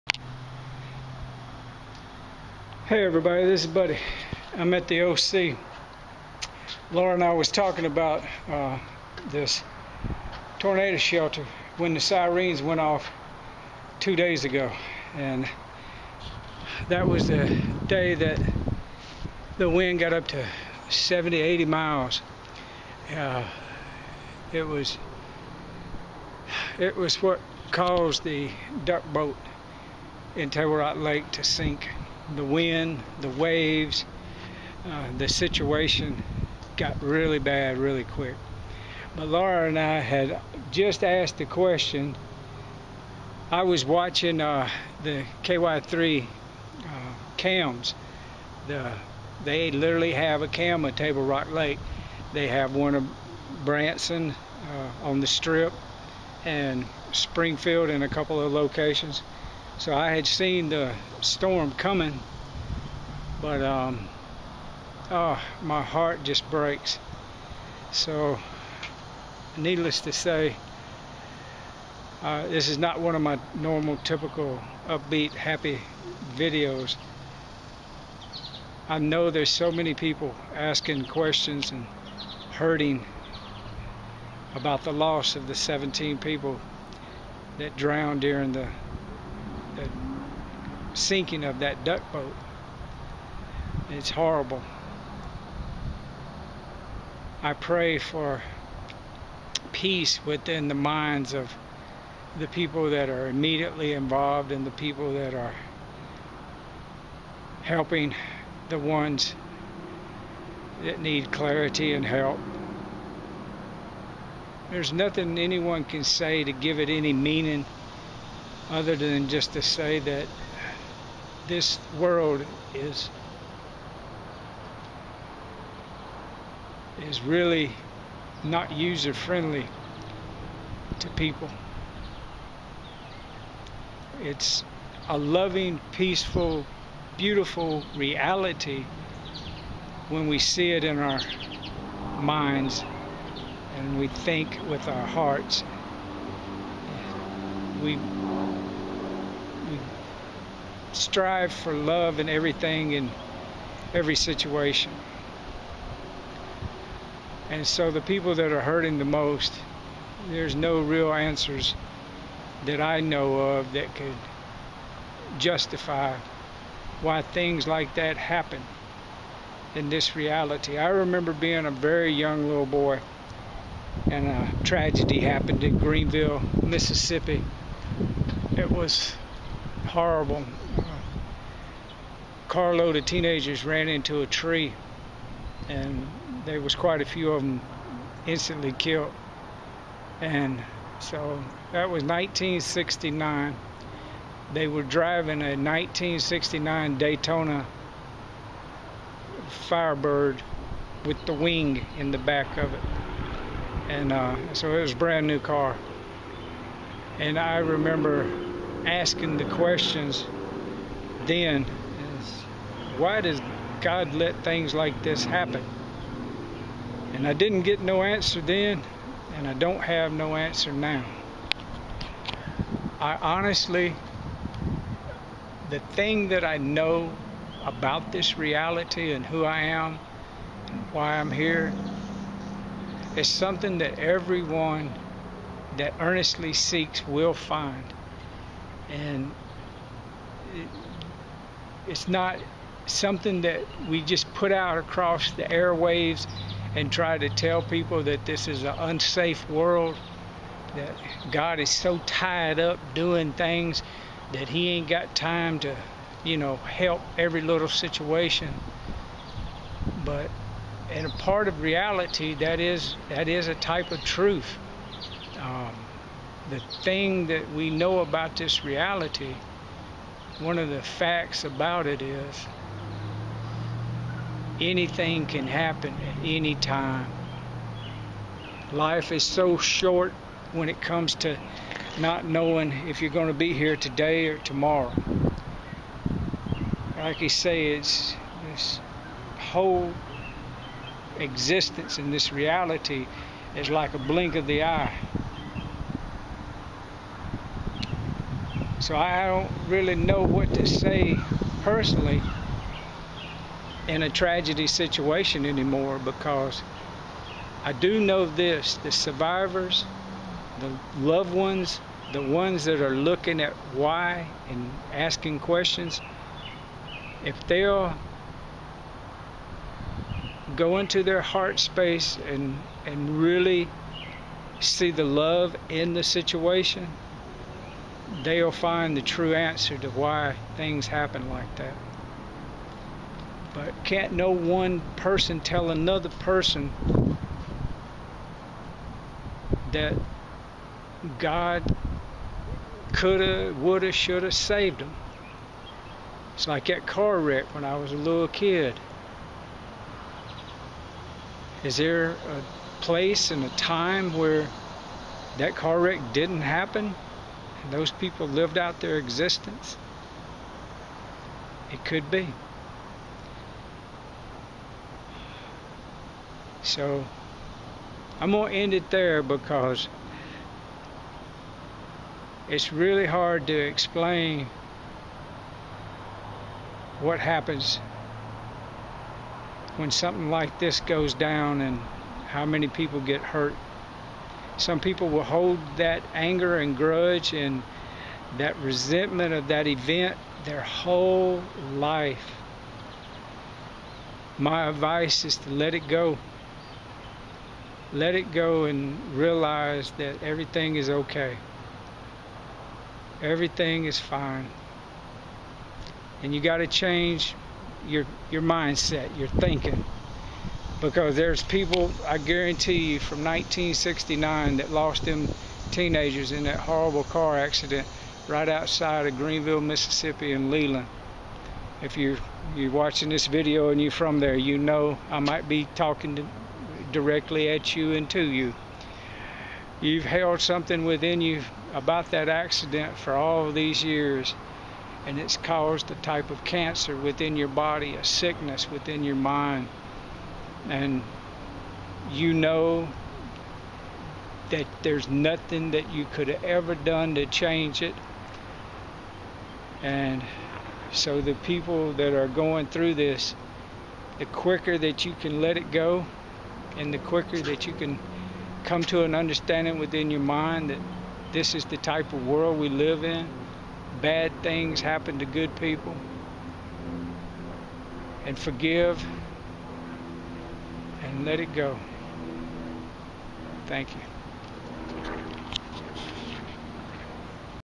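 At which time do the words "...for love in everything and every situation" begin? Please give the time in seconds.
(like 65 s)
151 s.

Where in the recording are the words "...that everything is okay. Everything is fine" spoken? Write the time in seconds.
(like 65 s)
399 s.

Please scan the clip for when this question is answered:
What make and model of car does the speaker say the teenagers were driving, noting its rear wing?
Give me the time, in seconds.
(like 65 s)
196 s.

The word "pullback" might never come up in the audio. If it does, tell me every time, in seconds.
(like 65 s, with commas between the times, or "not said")
not said.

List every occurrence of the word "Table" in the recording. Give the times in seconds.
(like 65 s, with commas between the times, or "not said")
30 s, 50 s.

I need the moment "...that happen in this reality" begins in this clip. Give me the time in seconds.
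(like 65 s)
167 s.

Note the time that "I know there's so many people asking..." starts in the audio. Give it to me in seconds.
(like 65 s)
78 s.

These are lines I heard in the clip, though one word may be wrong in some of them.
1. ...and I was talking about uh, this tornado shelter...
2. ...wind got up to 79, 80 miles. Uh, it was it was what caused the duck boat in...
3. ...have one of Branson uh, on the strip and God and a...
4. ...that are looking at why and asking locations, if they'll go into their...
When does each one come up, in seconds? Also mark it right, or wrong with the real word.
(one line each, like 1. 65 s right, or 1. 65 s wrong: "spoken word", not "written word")
1. 7 s right
2. 19 s wrong: "70", not "79"
3. 52 s wrong: "Springfield", not "God"
4. 312 s wrong: "questions", not "locations".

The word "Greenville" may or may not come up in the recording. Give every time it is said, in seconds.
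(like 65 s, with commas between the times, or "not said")
175 s, 419 s.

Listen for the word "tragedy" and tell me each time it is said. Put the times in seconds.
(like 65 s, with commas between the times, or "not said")
174 s, 304 s.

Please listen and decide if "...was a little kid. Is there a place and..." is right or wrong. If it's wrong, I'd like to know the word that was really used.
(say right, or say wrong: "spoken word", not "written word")
right.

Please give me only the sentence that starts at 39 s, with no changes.
But Laura and I had just asked the question.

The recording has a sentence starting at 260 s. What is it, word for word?
But in a part of reality that is that is a type of truth.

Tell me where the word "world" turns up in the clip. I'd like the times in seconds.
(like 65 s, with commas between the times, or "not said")
121 s, 249 s, 462 s.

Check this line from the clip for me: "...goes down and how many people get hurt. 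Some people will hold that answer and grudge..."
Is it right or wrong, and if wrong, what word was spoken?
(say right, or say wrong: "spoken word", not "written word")
wrong: "anger", not "answer".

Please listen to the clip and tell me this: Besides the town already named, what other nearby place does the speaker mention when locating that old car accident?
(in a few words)
Leland.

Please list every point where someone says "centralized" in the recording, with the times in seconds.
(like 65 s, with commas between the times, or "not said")
not said.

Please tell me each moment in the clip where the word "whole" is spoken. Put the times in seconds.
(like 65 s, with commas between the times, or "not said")
289 s, 390 s.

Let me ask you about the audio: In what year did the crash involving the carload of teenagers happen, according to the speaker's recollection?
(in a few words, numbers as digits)
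1969.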